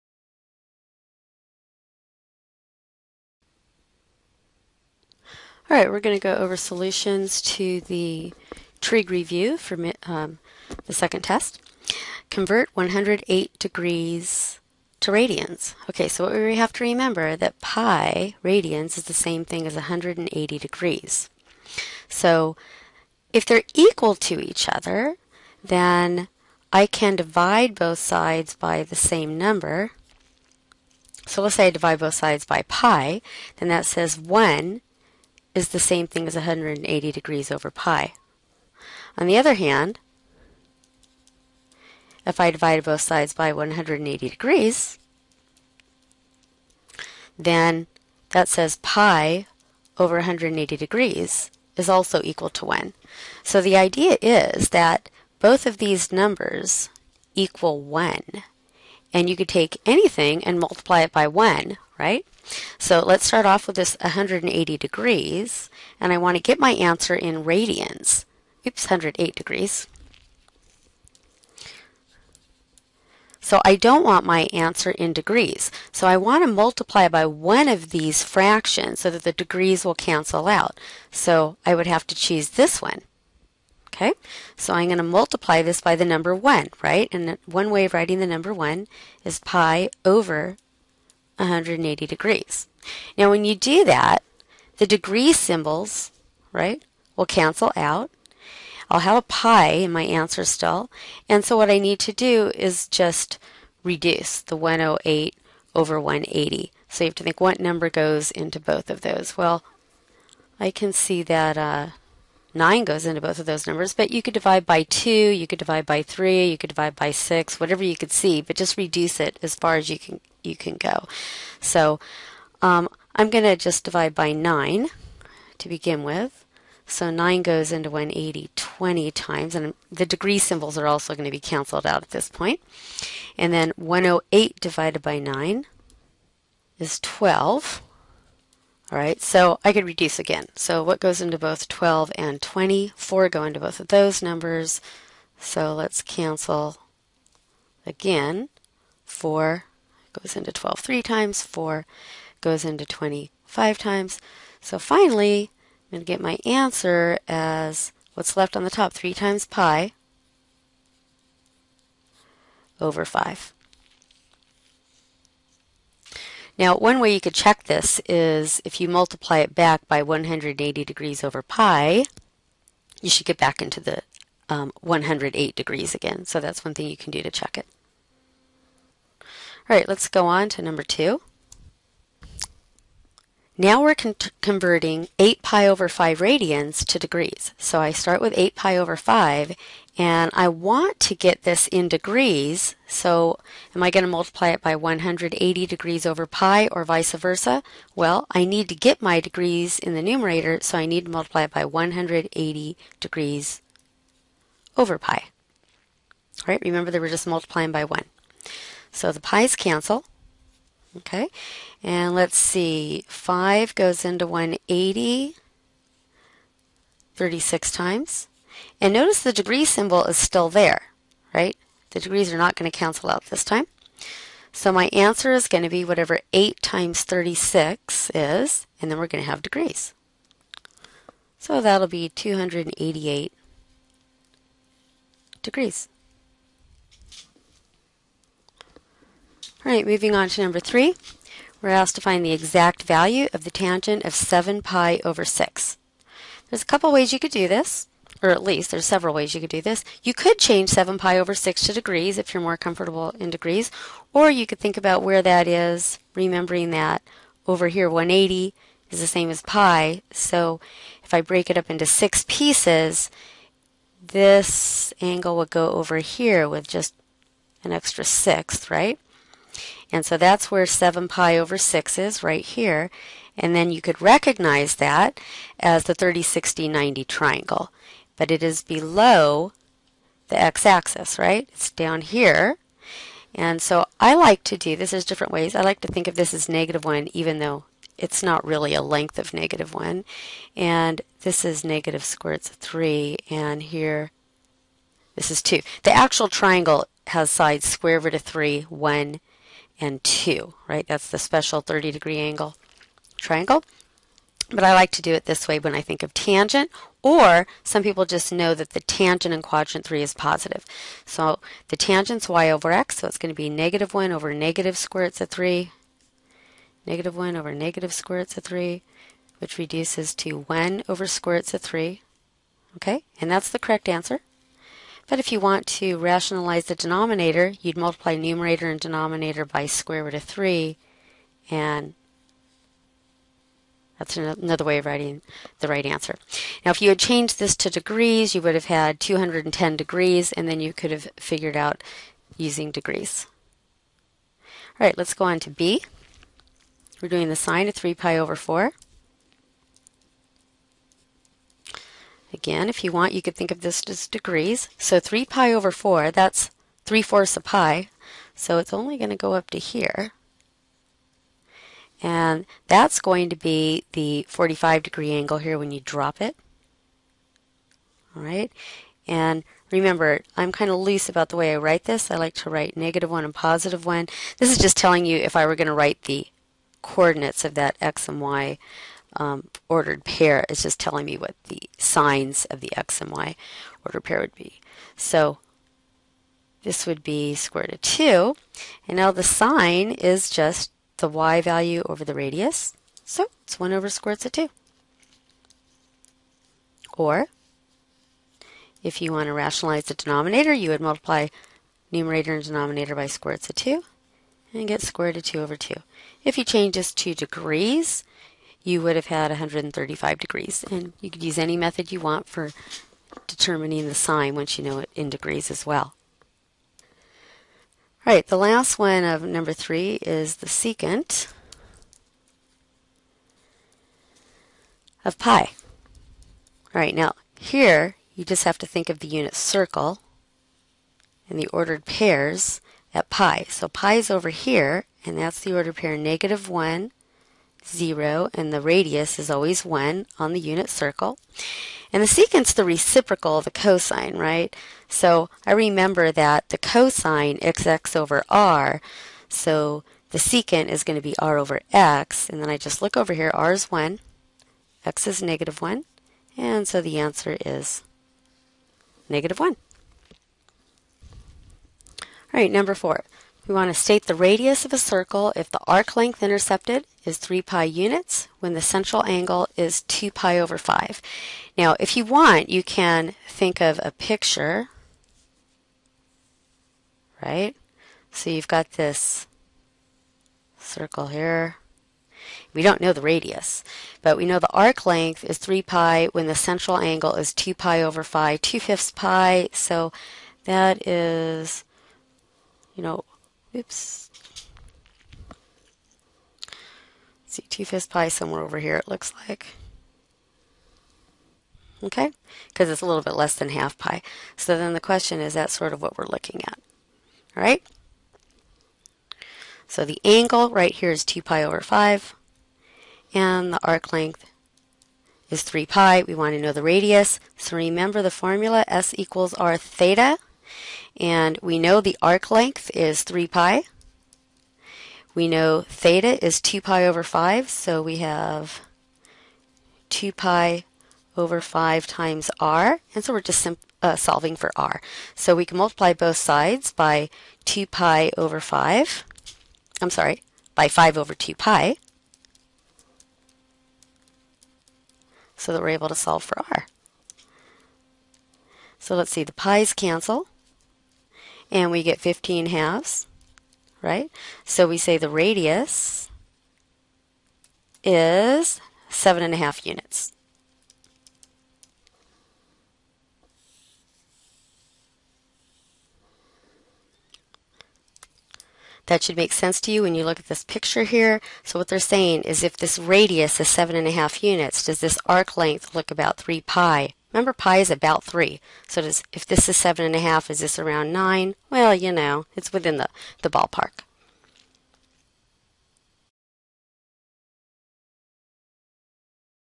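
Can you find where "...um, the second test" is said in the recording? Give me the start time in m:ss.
0:10.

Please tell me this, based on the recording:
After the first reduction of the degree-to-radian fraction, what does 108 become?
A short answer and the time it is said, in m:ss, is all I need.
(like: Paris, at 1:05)
12, at 2:13.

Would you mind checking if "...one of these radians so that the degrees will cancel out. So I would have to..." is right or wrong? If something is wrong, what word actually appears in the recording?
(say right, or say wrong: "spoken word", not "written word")
wrong: "fractions", not "radians".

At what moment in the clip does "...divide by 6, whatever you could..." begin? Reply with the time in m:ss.
1:56.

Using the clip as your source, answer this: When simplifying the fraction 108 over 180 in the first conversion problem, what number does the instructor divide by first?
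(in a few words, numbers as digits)
9.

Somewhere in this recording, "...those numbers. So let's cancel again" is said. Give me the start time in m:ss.
2:23.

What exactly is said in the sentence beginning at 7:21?
And the secant's the reciprocal of the cosine, right?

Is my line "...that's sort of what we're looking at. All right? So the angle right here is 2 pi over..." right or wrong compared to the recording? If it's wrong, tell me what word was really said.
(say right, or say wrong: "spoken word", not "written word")
right.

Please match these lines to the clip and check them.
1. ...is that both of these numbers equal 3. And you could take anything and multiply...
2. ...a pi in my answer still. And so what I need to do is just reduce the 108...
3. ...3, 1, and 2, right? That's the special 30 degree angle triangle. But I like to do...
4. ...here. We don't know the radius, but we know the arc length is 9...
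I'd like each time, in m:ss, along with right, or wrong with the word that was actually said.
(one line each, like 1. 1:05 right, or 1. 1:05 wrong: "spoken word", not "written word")
1. 0:54 wrong: "1", not "3"
2. 1:39 right
3. 4:58 right
4. 8:01 wrong: "3", not "9".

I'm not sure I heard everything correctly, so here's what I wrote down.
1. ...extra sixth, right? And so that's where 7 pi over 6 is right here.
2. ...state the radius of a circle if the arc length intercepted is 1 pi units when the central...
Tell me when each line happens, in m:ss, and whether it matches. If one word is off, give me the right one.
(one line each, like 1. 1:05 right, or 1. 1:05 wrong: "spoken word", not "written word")
1. 4:27 right
2. 7:43 wrong: "3", not "1".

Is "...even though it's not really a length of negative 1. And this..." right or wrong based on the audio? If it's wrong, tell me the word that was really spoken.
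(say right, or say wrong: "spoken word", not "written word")
right.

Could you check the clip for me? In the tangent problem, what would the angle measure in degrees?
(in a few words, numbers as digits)
210 degrees.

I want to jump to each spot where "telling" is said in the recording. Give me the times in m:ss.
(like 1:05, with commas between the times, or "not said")
6:14, 6:20.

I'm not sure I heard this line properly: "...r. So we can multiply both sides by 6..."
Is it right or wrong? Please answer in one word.
wrong.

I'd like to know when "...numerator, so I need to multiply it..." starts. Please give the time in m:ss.
3:20.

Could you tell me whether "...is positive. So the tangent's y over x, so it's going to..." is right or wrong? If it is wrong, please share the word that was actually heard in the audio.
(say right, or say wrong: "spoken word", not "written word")
right.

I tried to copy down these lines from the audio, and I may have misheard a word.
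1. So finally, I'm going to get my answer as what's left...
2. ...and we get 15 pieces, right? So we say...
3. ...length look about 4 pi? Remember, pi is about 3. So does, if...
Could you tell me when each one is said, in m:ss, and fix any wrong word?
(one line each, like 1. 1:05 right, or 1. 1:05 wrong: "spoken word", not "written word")
1. 2:34 right
2. 9:11 wrong: "halves", not "pieces"
3. 9:35 wrong: "3", not "4".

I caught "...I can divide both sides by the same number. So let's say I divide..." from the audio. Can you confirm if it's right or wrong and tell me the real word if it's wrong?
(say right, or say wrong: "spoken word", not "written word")
right.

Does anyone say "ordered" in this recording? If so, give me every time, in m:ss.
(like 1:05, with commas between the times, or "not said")
6:19, 6:23, 7:11, 7:15.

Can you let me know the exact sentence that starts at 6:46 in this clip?
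If you change this to degrees, you would have had 135 degrees.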